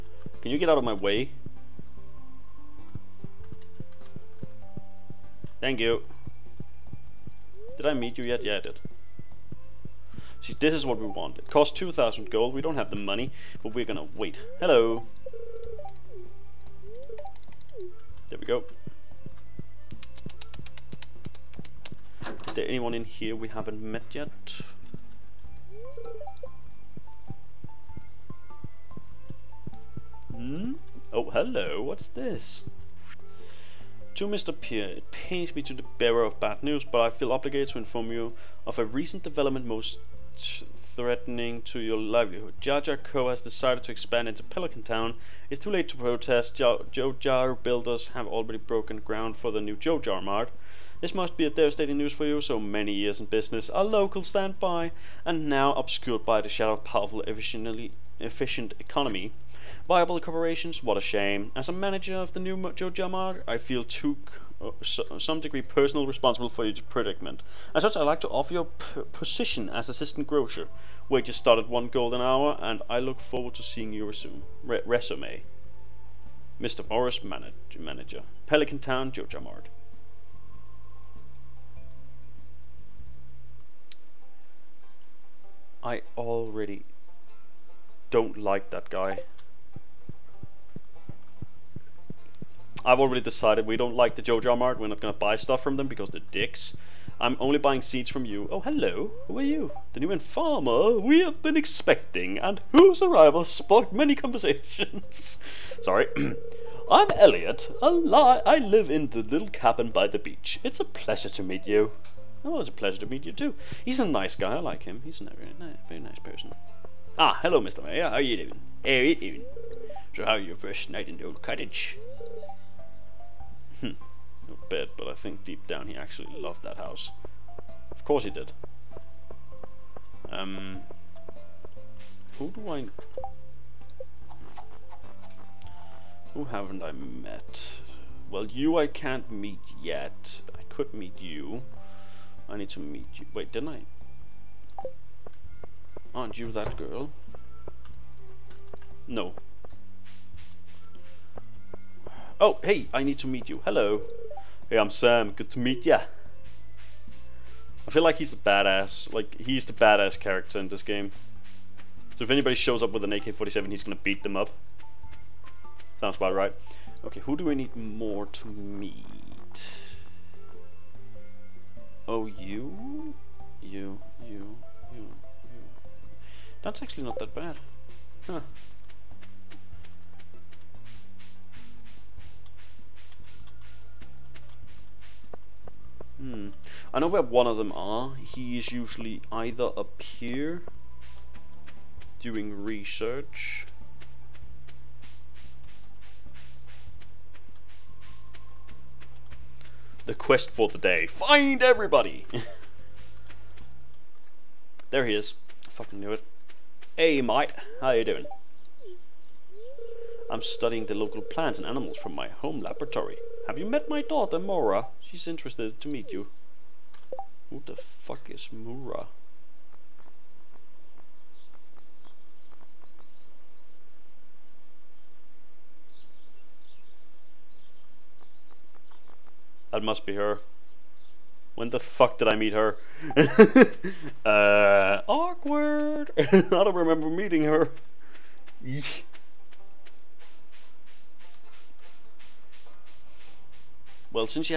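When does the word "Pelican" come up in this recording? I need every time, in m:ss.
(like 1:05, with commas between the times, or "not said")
0:44, 1:18.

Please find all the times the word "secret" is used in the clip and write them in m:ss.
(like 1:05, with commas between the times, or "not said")
not said.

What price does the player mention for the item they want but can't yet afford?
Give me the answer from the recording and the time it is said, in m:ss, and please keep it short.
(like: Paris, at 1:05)
2,000 gold, at 0:11.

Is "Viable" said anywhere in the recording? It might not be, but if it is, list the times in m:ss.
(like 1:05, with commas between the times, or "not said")
0:59.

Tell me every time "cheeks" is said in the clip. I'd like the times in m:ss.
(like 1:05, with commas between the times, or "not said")
not said.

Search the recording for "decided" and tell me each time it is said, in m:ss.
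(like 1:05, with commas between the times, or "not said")
0:43, 1:33.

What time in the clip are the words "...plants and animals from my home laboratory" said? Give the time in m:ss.
3:31.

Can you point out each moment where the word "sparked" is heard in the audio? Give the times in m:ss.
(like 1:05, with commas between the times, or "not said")
1:43.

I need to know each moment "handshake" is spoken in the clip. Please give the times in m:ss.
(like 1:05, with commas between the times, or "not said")
not said.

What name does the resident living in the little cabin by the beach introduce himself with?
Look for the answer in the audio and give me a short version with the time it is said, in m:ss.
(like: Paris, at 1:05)
Elliot, at 1:47.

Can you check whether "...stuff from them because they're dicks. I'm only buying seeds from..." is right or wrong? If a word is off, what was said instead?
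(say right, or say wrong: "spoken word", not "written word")
right.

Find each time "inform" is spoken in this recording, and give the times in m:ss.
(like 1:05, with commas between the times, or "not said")
0:37.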